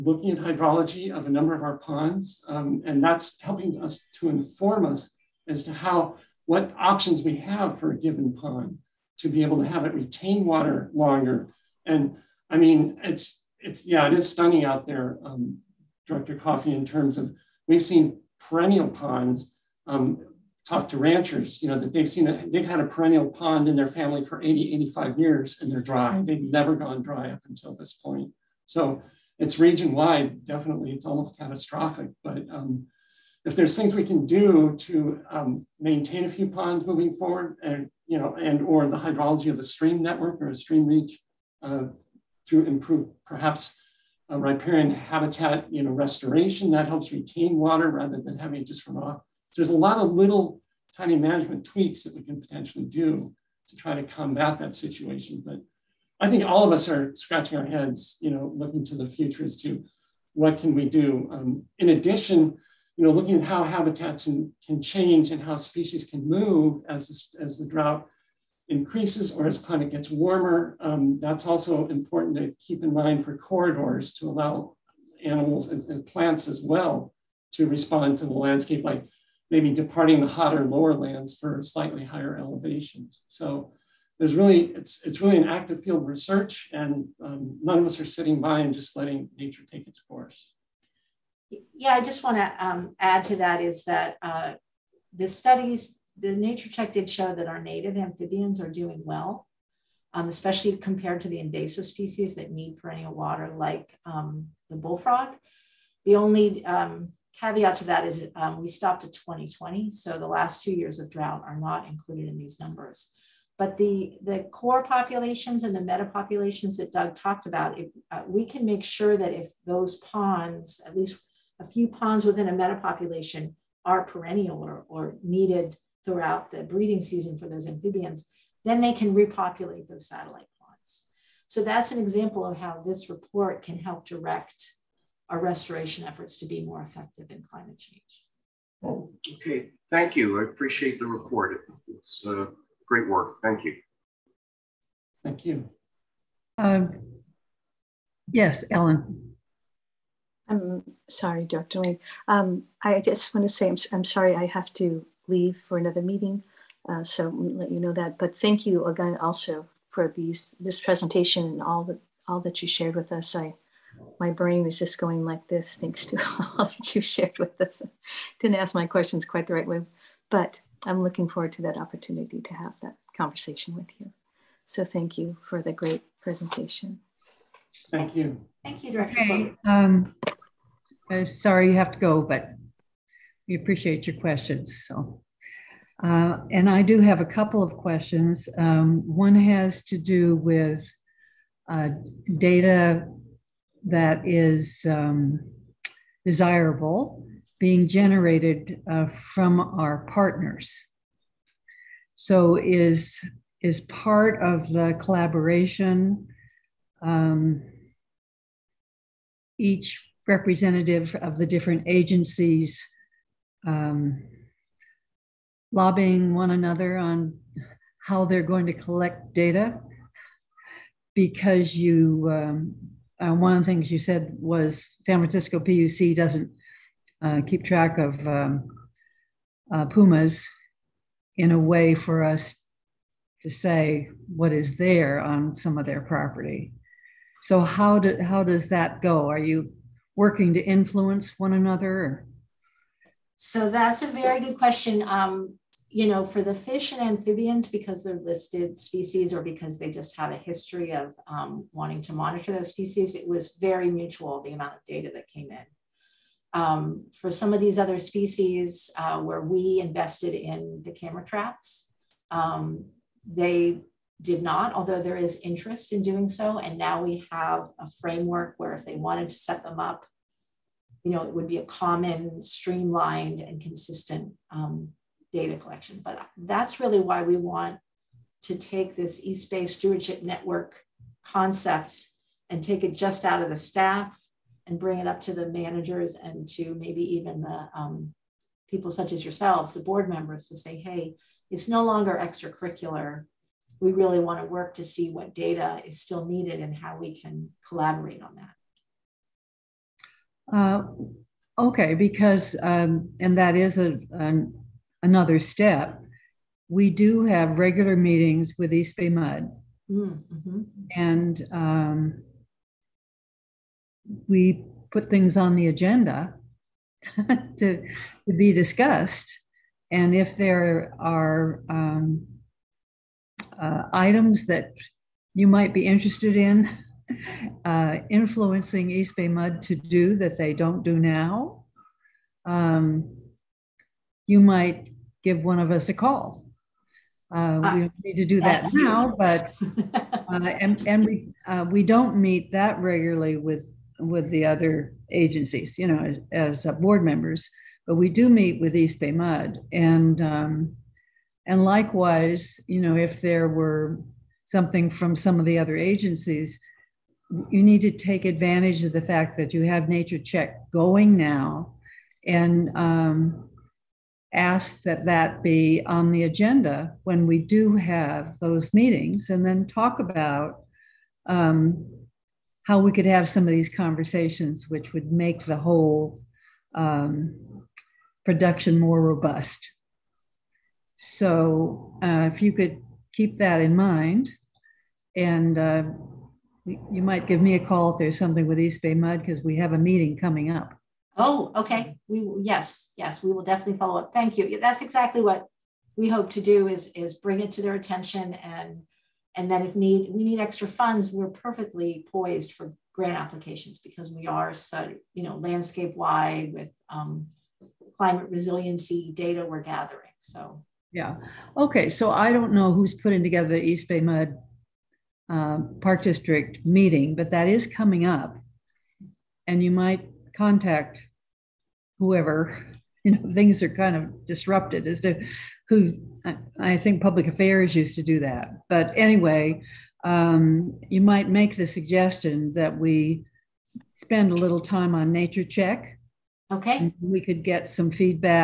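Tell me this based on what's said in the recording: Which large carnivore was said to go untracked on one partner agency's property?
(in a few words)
Pumas.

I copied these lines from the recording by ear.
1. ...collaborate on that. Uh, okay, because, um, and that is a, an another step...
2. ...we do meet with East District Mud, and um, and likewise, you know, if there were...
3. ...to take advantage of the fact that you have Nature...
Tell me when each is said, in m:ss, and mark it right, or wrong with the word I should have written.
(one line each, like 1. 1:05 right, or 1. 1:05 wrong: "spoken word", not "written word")
1. 4:57 right
2. 5:47 wrong: "Bay", not "District"
3. 5:57 right.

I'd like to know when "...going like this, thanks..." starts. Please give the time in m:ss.
2:44.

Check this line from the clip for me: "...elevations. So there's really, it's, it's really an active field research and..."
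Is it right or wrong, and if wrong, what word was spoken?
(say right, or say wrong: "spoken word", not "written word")
right.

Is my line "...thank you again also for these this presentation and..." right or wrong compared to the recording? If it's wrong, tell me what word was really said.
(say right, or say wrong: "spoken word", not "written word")
right.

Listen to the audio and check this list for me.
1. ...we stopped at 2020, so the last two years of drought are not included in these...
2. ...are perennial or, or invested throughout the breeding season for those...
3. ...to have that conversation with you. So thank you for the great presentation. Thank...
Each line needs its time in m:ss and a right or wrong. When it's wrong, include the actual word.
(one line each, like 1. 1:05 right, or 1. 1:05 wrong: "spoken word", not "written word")
1. 1:48 right
2. 2:03 wrong: "needed", not "invested"
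3. 2:52 right.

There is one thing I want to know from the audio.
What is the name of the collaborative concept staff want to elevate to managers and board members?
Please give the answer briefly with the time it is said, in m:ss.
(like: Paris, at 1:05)
East Bay Stewardship Network, at 4:39.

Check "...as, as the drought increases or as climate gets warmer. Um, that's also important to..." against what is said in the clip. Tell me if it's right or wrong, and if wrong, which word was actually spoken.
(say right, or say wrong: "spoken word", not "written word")
right.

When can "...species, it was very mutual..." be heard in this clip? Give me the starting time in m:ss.
4:12.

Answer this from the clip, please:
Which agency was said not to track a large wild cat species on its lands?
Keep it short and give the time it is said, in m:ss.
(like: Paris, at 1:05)
San Francisco PUC, at 3:45.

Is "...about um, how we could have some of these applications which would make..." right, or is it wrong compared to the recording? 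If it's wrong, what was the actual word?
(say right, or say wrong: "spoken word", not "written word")
wrong: "conversations", not "applications".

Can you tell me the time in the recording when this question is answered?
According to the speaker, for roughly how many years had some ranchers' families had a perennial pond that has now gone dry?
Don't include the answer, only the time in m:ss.
0:24.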